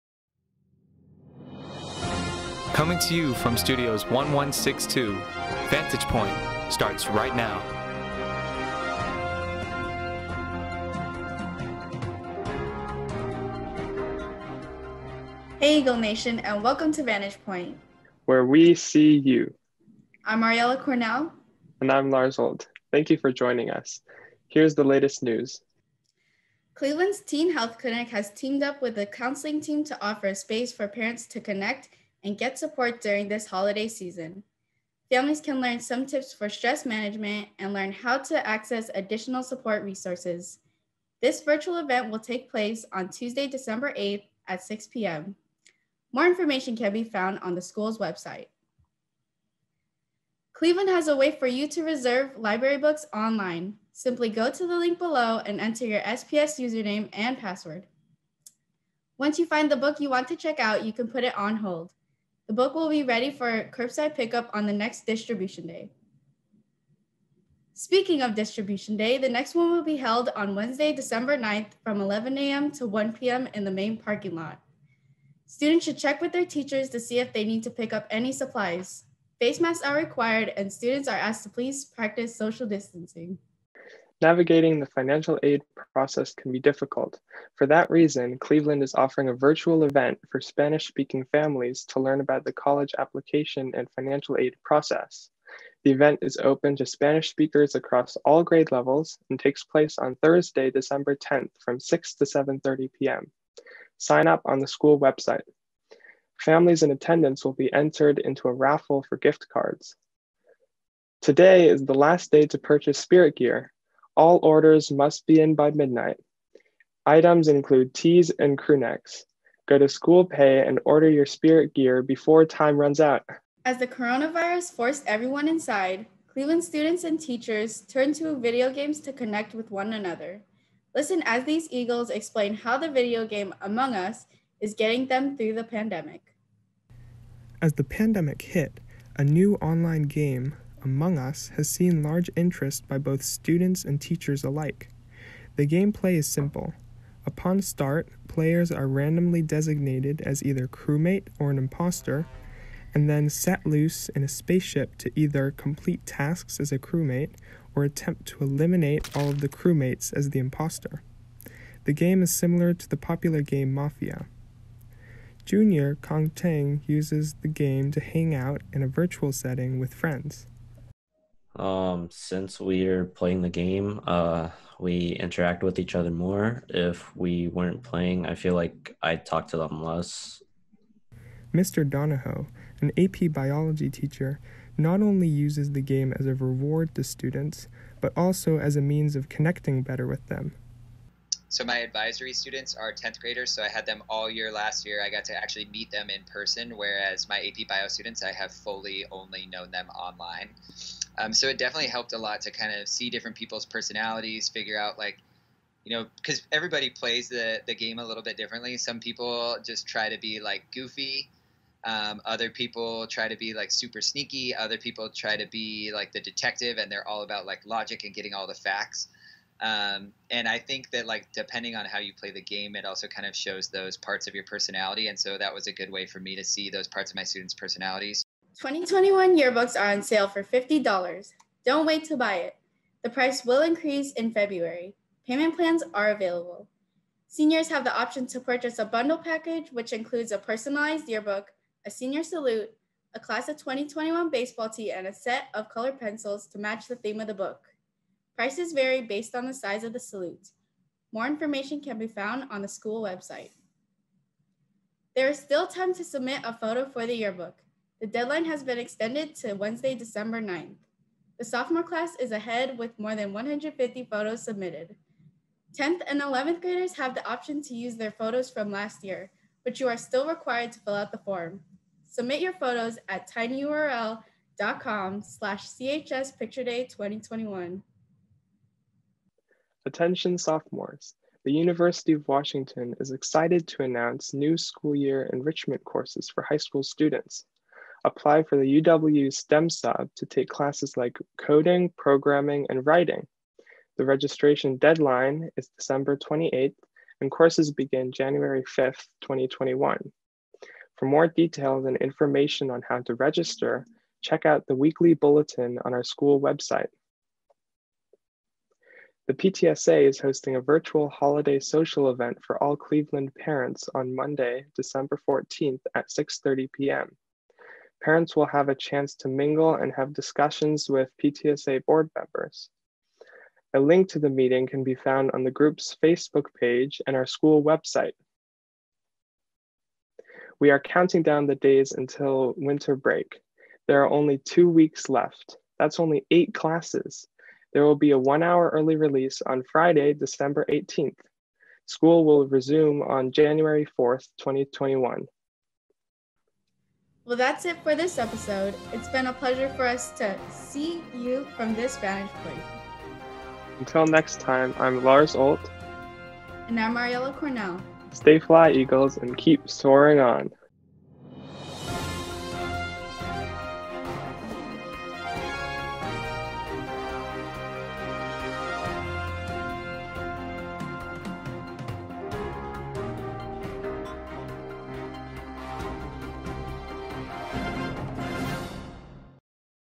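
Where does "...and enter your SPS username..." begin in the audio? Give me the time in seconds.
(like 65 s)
55 s.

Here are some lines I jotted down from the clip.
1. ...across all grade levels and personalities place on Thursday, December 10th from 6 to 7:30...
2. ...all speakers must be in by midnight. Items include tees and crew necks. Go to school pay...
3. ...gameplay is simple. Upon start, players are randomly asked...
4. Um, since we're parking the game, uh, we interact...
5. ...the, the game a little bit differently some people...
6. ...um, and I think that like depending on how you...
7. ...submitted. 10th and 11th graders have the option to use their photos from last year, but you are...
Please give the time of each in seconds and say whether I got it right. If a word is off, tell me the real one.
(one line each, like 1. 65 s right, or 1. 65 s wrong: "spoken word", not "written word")
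1. 97 s wrong: "takes", not "personalities"
2. 114 s wrong: "orders", not "speakers"
3. 145 s wrong: "designated", not "asked"
4. 171 s wrong: "playing", not "parking"
5. 207 s right
6. 219 s right
7. 264 s right.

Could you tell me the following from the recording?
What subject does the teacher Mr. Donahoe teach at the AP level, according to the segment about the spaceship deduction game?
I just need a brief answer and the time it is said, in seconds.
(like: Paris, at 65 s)
biology, at 182 s.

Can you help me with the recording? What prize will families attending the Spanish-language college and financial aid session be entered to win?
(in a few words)
gift cards.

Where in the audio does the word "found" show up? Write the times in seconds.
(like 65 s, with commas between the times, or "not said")
47 s, 252 s, 324 s.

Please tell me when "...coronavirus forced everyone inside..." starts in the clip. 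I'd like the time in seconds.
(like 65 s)
123 s.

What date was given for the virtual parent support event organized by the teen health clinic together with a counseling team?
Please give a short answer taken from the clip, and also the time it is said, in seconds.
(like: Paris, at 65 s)
Tuesday, December 8th, at 43 s.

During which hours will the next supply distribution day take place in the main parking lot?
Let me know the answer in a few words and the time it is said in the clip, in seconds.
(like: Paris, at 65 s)
11 a.m. to 1 p.m., at 72 s.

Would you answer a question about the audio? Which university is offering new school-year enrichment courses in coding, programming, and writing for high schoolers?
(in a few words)
University of Washington.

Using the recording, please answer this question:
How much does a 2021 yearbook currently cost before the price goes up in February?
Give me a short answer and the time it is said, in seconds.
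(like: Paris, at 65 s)
$50, at 230 s.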